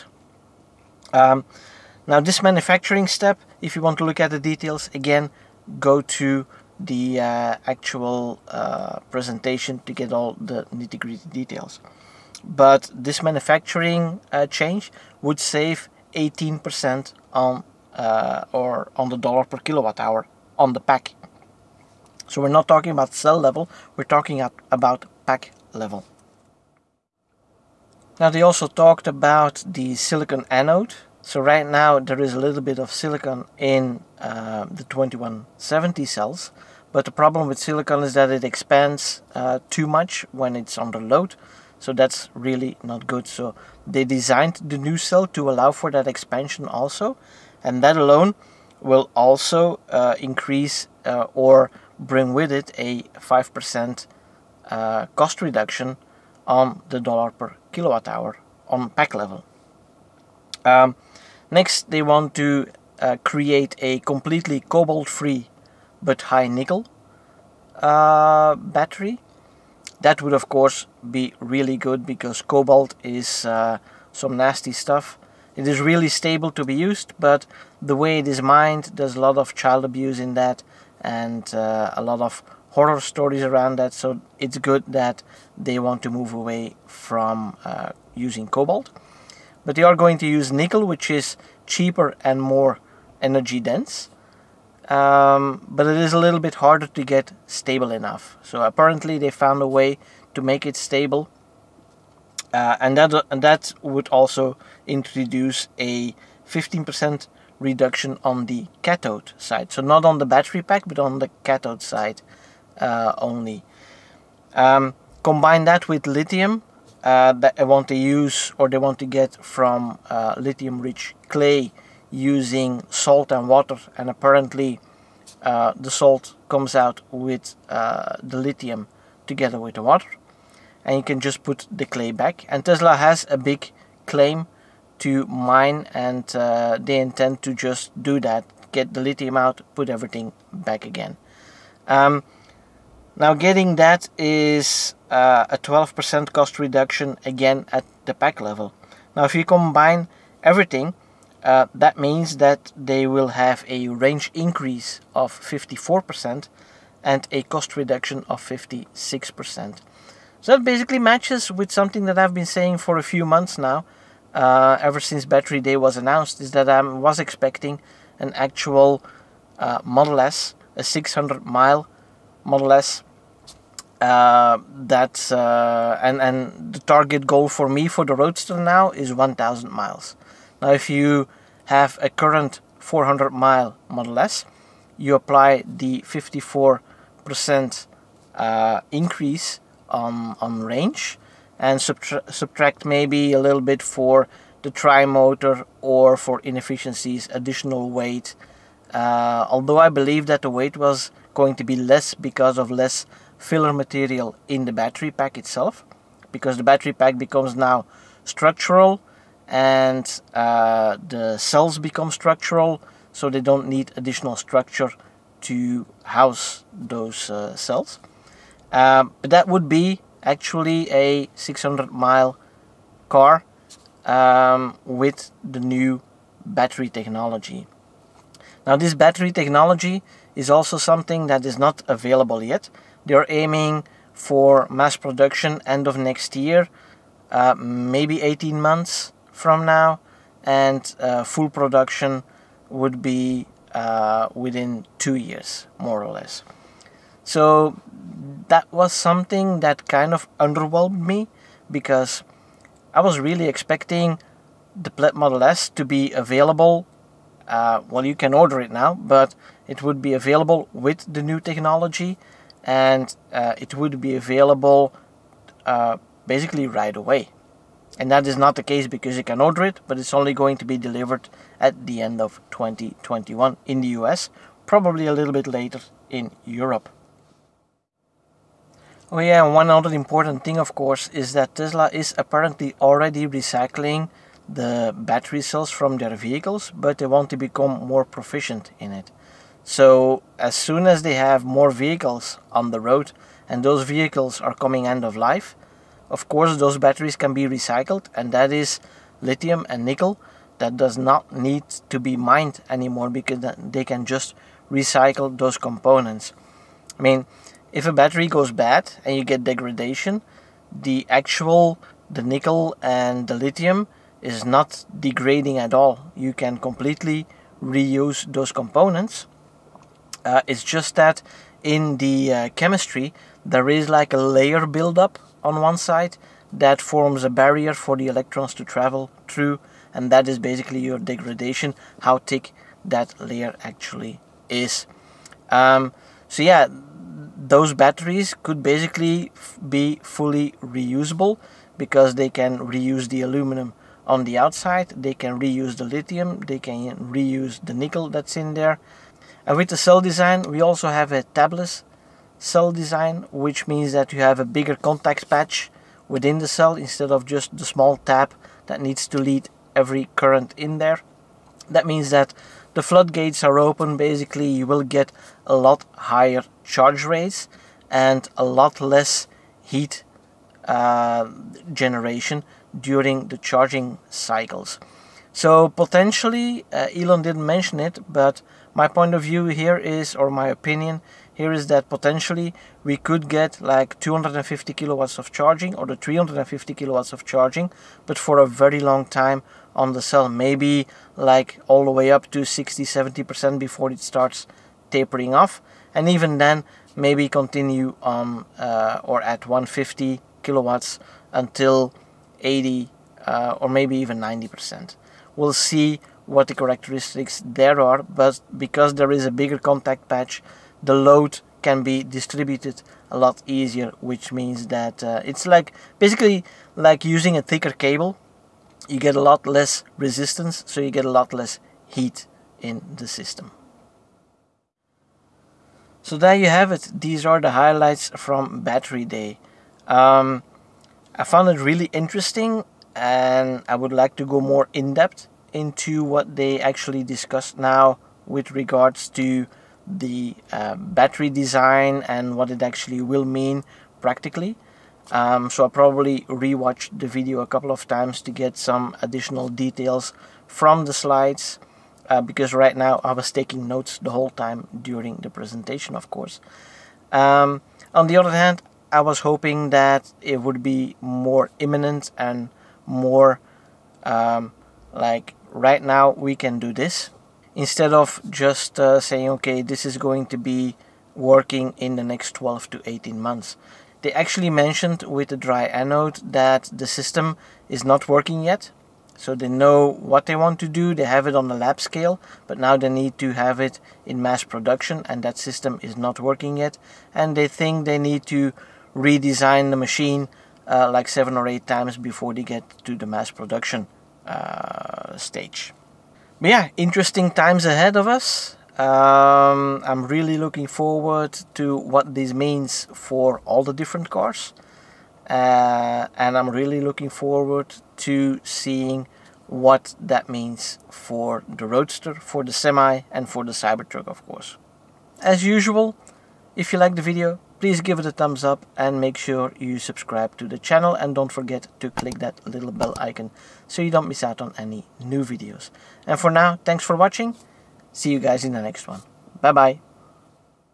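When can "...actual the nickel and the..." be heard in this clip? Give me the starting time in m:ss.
5:11.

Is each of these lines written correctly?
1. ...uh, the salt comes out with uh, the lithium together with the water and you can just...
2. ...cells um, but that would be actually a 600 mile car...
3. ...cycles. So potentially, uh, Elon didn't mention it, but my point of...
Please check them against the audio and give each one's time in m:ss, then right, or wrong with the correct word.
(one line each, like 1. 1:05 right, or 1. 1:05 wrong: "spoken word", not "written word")
1. 2:05 right
2. 3:37 right
3. 6:14 right.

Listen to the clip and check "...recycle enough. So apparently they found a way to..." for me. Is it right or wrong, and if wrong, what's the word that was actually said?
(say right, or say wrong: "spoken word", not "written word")
wrong: "stable", not "recycle".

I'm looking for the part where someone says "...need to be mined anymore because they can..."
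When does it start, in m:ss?
5:01.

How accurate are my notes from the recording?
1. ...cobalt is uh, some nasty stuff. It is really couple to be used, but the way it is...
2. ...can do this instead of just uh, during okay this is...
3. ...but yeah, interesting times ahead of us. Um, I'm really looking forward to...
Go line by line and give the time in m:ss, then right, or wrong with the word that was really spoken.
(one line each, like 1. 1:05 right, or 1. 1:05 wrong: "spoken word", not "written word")
1. 1:12 wrong: "stable", not "couple"
2. 7:46 wrong: "saying", not "during"
3. 8:16 right.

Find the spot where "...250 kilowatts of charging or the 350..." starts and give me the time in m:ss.
6:23.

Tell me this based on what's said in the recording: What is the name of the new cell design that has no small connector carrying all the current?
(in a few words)
tabless cell design.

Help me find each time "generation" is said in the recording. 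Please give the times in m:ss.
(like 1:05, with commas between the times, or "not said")
6:11.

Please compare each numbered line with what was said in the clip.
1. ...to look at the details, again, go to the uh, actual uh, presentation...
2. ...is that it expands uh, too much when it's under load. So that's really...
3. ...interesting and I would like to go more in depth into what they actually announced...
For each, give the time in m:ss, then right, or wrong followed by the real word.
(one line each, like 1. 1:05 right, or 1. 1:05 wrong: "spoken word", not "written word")
1. 0:03 right
2. 0:38 right
3. 7:11 wrong: "discussed", not "announced".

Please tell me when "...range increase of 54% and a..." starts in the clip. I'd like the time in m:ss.
2:33.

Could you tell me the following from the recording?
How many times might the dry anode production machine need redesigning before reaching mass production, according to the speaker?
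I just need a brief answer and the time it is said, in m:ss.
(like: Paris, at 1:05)
7 or 8, at 8:11.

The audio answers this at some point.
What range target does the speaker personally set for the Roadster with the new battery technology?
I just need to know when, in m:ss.
2:59.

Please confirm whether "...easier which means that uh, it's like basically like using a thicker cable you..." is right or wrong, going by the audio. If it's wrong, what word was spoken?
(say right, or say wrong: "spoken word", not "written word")
right.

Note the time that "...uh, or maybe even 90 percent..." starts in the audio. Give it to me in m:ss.
6:43.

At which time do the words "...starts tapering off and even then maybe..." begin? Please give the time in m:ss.
6:34.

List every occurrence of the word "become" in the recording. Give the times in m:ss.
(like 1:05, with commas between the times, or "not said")
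3:27, 3:31, 4:47.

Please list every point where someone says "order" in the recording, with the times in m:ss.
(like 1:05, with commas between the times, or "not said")
4:18, 4:29.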